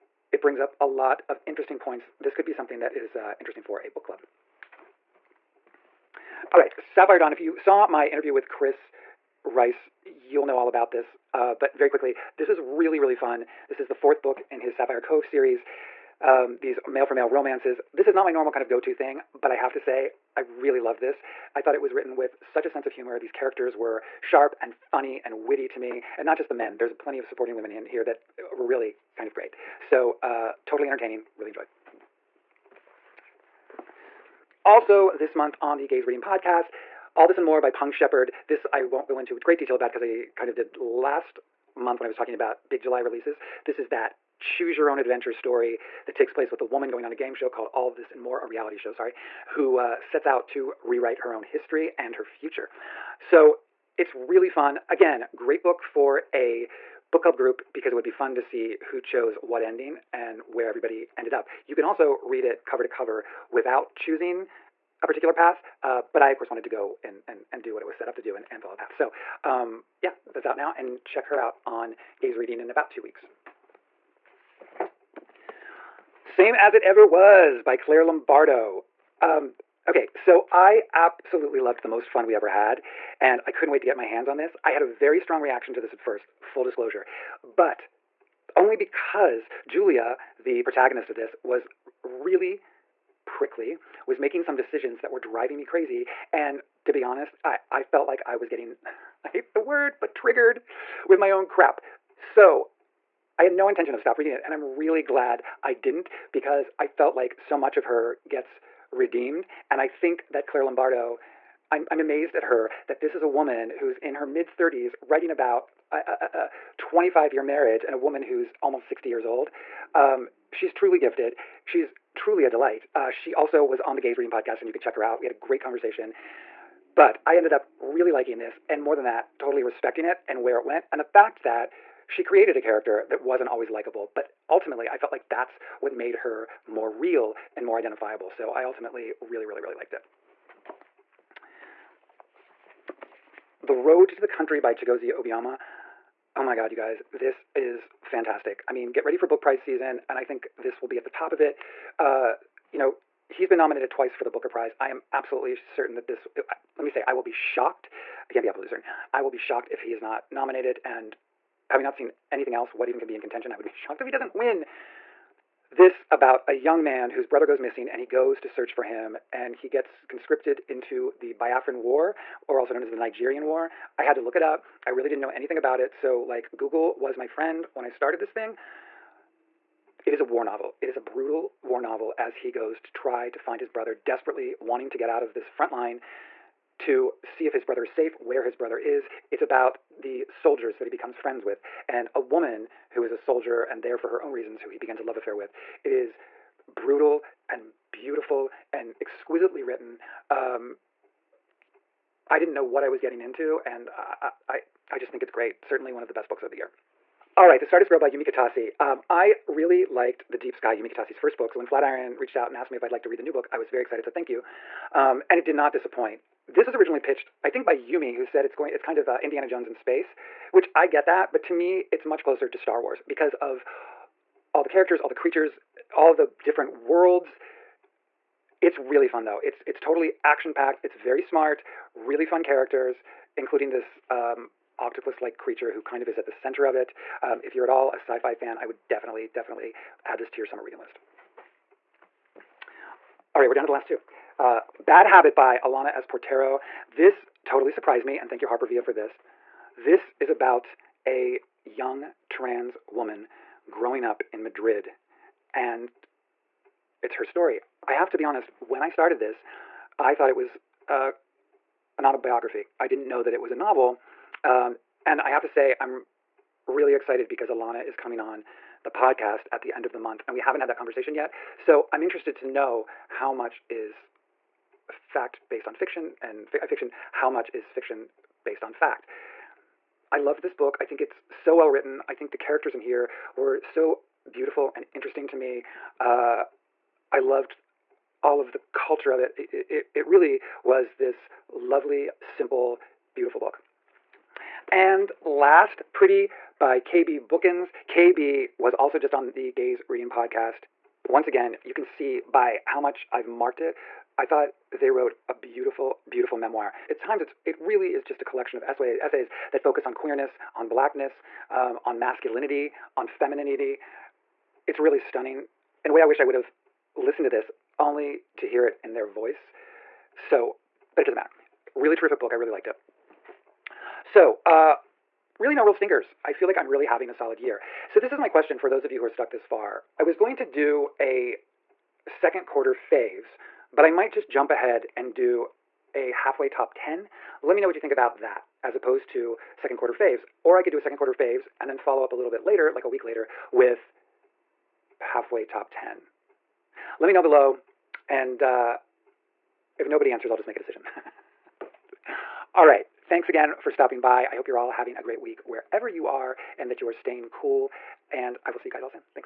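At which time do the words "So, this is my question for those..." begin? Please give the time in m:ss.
5:27.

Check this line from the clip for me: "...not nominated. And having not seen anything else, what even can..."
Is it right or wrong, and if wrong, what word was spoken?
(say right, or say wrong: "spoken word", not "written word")
right.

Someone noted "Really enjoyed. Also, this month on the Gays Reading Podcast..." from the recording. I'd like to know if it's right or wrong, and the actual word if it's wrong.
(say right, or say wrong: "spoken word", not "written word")
right.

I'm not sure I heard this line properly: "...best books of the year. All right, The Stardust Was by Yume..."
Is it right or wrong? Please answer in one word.
wrong.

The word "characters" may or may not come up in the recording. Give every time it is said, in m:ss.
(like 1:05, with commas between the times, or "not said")
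0:23, 2:12, 3:44, 3:52, 4:42.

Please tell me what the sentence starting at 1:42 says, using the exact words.
So I had no intention of stop reading it.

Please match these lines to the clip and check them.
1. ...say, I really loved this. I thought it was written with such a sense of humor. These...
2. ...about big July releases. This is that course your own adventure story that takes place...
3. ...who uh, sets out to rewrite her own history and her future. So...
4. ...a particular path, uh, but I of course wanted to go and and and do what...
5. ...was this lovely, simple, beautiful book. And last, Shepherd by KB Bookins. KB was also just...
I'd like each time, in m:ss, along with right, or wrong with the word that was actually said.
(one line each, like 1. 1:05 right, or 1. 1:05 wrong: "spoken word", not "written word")
1. 0:19 right
2. 0:42 wrong: "choose", not "course"
3. 0:49 right
4. 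1:05 right
5. 4:50 wrong: "Pretty", not "Shepherd".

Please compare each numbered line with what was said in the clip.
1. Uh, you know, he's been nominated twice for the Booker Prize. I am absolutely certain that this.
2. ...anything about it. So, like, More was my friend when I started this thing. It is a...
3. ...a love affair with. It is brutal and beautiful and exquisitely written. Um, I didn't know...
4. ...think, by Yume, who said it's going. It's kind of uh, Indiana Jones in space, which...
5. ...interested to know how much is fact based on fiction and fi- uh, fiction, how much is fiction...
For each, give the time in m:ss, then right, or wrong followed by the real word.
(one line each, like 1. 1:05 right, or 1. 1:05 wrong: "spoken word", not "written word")
1. 2:31 right
2. 2:55 wrong: "Google", not "More"
3. 3:14 right
4. 3:37 right
5. 4:32 right.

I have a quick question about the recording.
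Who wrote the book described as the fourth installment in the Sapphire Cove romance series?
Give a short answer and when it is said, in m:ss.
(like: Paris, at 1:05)
Chris Rice, at 0:08.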